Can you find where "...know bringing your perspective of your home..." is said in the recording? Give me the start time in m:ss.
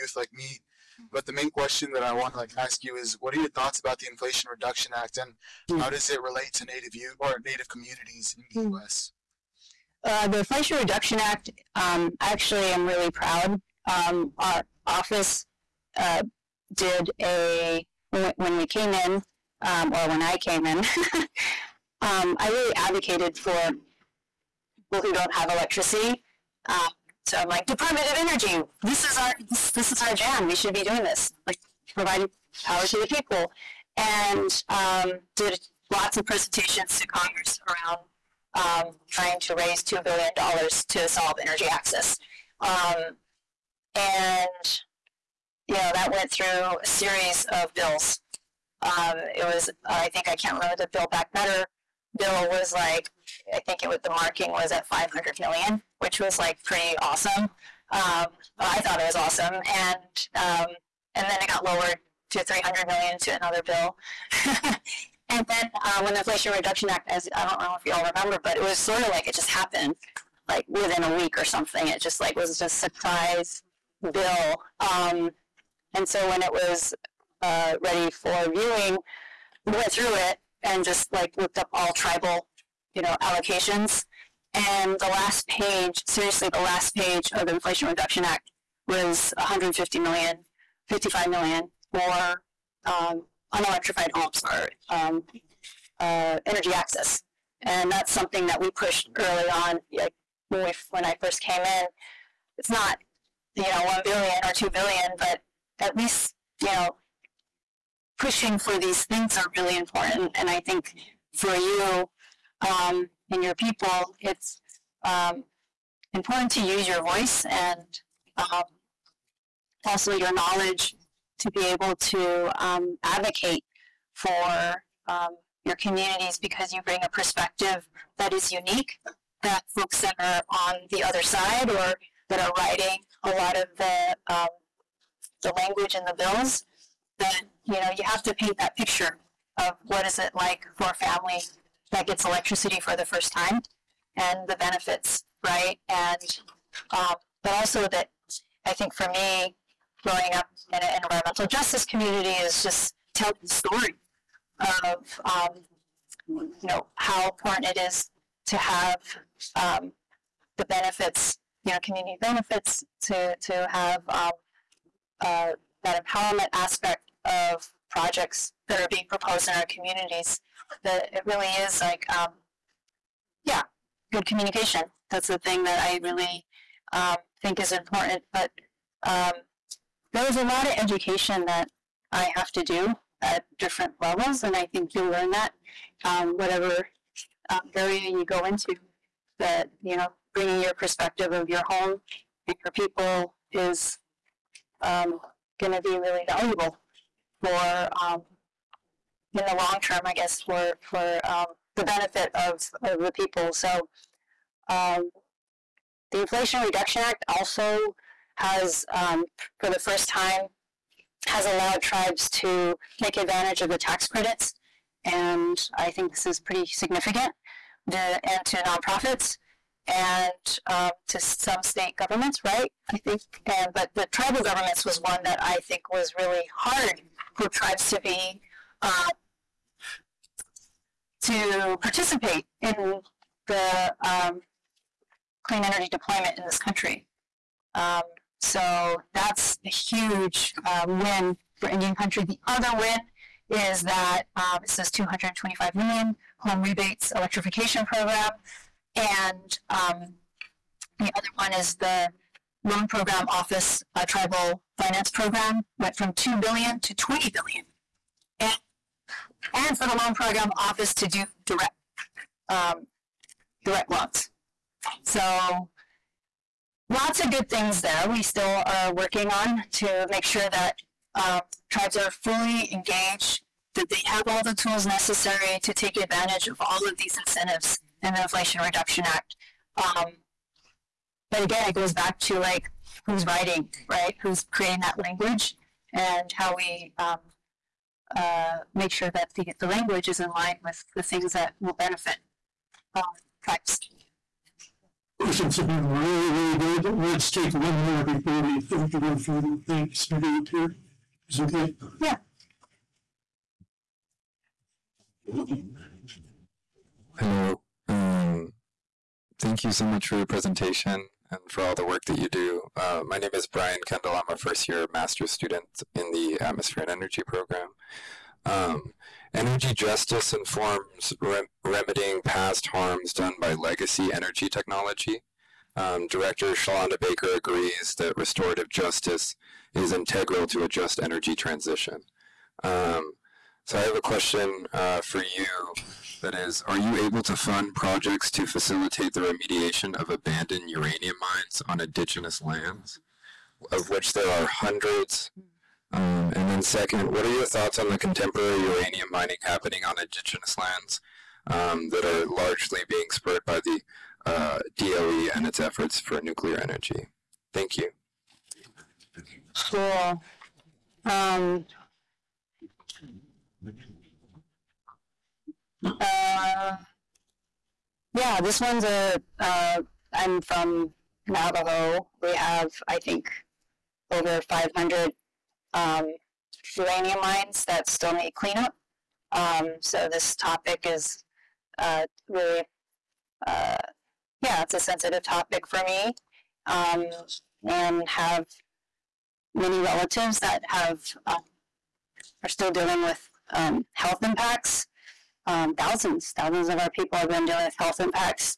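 3:09.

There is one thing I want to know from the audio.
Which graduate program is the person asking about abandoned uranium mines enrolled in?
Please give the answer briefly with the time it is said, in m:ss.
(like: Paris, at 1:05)
Atmosphere and Energy, at 5:16.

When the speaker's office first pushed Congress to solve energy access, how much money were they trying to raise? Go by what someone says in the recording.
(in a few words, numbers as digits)
2 billion dollars.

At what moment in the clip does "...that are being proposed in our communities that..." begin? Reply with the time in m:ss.
2:48.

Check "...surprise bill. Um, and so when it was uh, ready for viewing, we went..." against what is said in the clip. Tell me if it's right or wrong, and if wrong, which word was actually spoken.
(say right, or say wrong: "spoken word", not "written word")
right.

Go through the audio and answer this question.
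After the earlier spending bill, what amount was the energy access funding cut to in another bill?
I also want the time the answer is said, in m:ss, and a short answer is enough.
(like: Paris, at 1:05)
300 million, at 1:02.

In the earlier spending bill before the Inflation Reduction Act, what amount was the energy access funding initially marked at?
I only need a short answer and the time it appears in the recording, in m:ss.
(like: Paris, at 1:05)
500 million, at 0:54.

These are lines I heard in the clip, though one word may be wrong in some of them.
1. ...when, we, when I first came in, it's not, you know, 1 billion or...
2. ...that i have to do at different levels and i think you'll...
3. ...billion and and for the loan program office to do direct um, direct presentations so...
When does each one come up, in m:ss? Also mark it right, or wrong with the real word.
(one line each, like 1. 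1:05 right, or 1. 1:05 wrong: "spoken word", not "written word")
1. 1:40 right
2. 3:01 right
3. 4:17 wrong: "loans", not "presentations".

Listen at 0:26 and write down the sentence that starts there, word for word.
Um, so I'm like, Department of Energy, this is our this, this is our jam.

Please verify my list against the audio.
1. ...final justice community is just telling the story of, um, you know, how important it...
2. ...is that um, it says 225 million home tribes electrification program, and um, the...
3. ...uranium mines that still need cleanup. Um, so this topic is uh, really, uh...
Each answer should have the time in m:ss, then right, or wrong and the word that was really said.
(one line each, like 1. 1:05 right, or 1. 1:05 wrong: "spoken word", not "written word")
1. 2:31 wrong: "environmental", not "final"
2. 4:03 wrong: "rebates", not "tribes"
3. 6:16 right.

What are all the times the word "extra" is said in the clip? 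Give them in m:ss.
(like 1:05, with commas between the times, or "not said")
not said.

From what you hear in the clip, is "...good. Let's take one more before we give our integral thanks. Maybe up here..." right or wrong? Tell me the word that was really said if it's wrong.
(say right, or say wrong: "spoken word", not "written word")
wrong: "final", not "integral".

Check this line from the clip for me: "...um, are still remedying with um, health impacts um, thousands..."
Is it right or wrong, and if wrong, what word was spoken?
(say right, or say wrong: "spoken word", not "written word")
wrong: "dealing", not "remedying".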